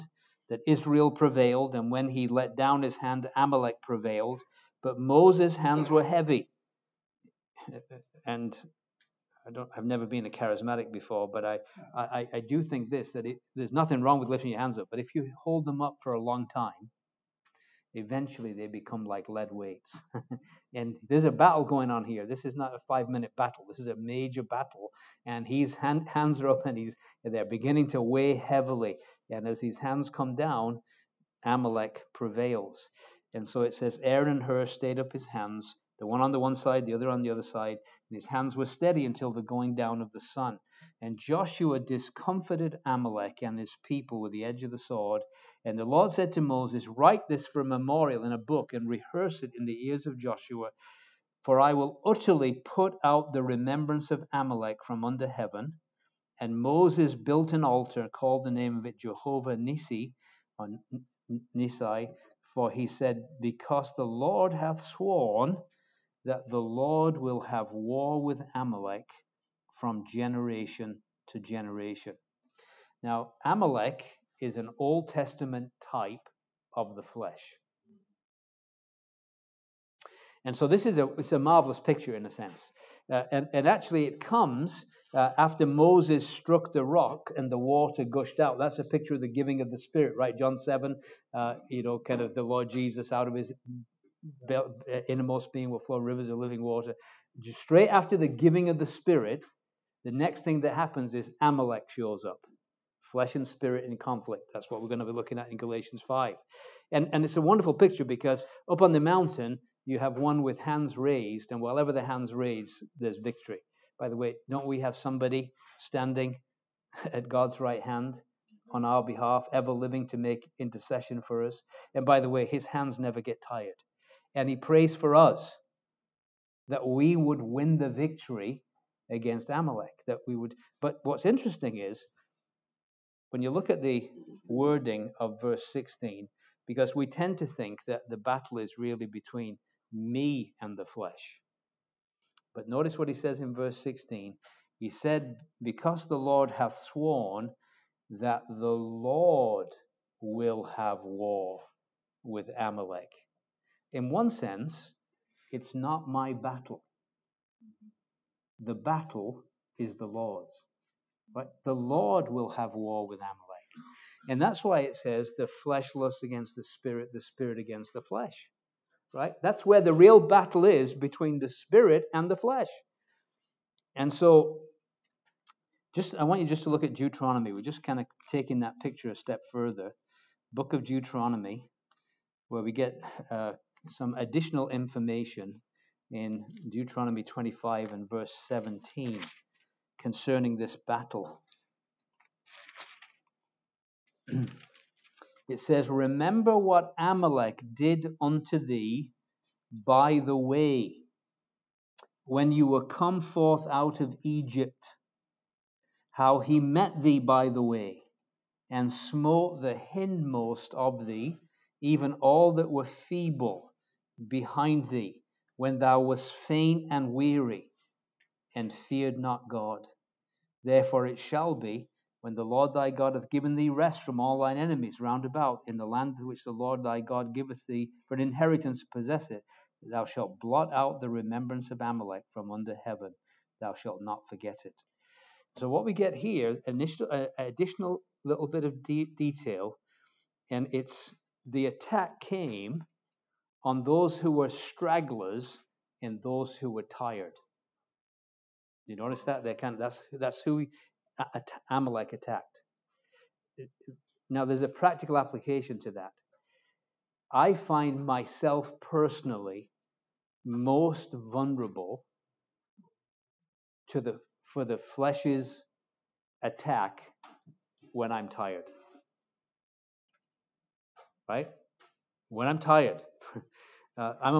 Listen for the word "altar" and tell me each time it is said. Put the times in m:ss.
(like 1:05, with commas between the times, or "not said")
0:57.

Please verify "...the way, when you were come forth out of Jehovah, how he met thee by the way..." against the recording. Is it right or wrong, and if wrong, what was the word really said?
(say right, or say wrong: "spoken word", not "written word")
wrong: "Egypt", not "Jehovah".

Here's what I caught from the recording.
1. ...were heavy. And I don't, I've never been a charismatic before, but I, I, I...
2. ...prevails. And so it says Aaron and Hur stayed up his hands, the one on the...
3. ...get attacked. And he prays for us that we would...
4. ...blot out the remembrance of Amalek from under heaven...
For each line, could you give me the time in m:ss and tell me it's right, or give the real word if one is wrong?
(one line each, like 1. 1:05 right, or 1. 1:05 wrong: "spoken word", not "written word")
1. 0:05 right
2. 0:32 right
3. 2:03 wrong: "tired", not "attacked"
4. 3:50 right.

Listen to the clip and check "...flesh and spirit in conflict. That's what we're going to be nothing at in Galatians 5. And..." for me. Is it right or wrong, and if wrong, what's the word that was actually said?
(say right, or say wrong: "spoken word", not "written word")
wrong: "looking", not "nothing".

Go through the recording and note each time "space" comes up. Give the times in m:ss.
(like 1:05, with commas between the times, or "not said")
not said.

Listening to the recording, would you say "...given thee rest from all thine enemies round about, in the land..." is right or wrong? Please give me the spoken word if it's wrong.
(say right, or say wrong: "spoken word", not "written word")
right.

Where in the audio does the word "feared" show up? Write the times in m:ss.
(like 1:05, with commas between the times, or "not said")
3:38.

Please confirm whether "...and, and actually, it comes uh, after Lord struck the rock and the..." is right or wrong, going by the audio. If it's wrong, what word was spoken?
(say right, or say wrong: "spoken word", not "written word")
wrong: "Moses", not "Lord".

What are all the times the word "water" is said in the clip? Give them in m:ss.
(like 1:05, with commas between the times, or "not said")
1:27, 1:36.